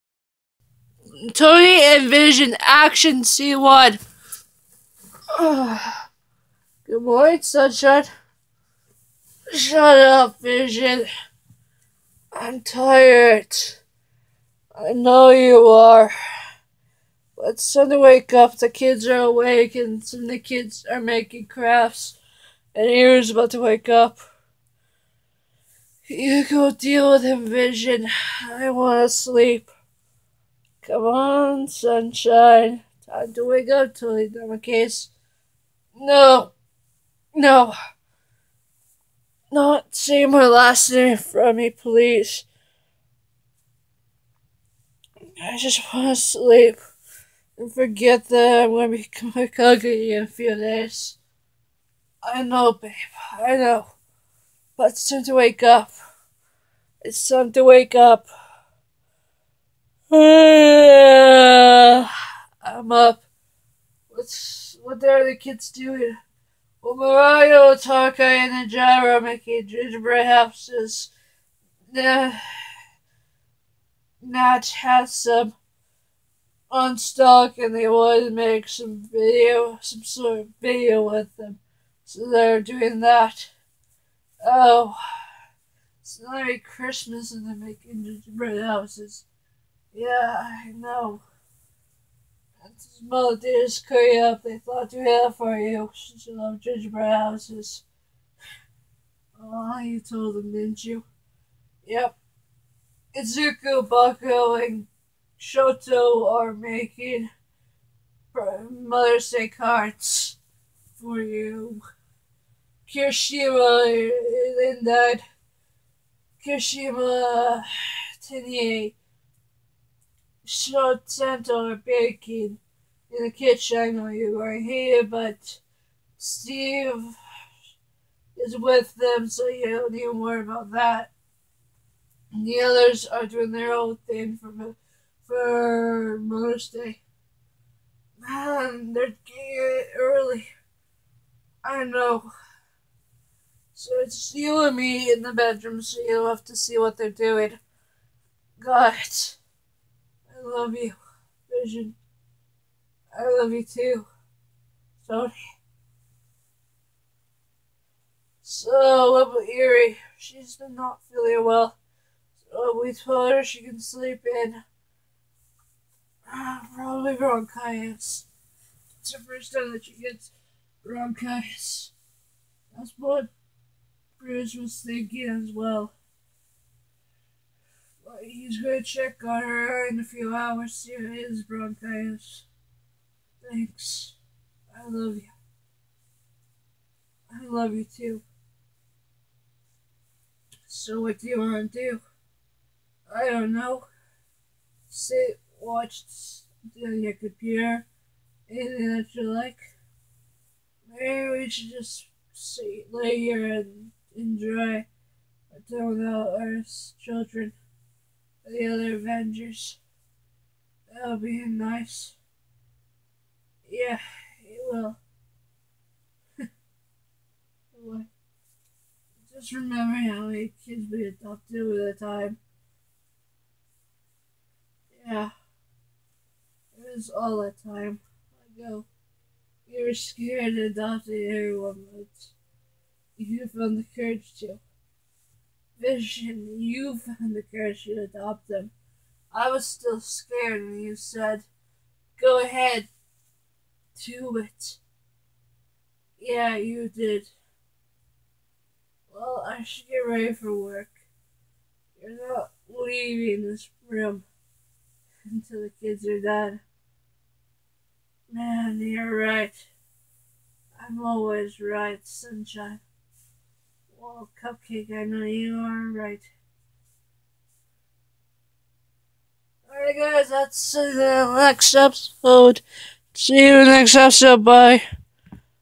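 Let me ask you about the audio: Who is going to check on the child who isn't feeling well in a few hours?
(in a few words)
Bruce.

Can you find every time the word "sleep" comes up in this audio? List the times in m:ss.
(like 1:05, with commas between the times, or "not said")
0:29, 0:46, 2:43.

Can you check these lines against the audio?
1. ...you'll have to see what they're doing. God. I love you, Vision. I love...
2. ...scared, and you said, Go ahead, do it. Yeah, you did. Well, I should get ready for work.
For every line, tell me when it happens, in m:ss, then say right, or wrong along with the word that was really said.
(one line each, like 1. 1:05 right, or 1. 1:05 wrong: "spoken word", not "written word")
1. 2:26 right
2. 3:59 right.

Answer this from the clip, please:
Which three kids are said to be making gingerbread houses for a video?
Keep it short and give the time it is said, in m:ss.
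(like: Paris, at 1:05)
Mirio, Tarka, and the Jara, at 1:06.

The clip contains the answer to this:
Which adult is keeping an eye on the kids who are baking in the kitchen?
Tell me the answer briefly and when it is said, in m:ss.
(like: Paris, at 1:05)
Steve, at 2:06.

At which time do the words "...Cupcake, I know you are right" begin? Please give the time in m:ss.
4:24.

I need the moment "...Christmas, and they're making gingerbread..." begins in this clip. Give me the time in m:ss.
1:26.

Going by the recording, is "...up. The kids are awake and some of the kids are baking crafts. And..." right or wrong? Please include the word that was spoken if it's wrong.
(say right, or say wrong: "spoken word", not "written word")
wrong: "making", not "baking".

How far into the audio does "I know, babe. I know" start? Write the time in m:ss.
0:52.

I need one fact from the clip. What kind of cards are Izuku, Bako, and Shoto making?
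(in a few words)
Mother's Day cards.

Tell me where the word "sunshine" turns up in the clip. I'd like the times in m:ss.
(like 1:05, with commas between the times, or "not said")
0:07, 0:31, 4:22.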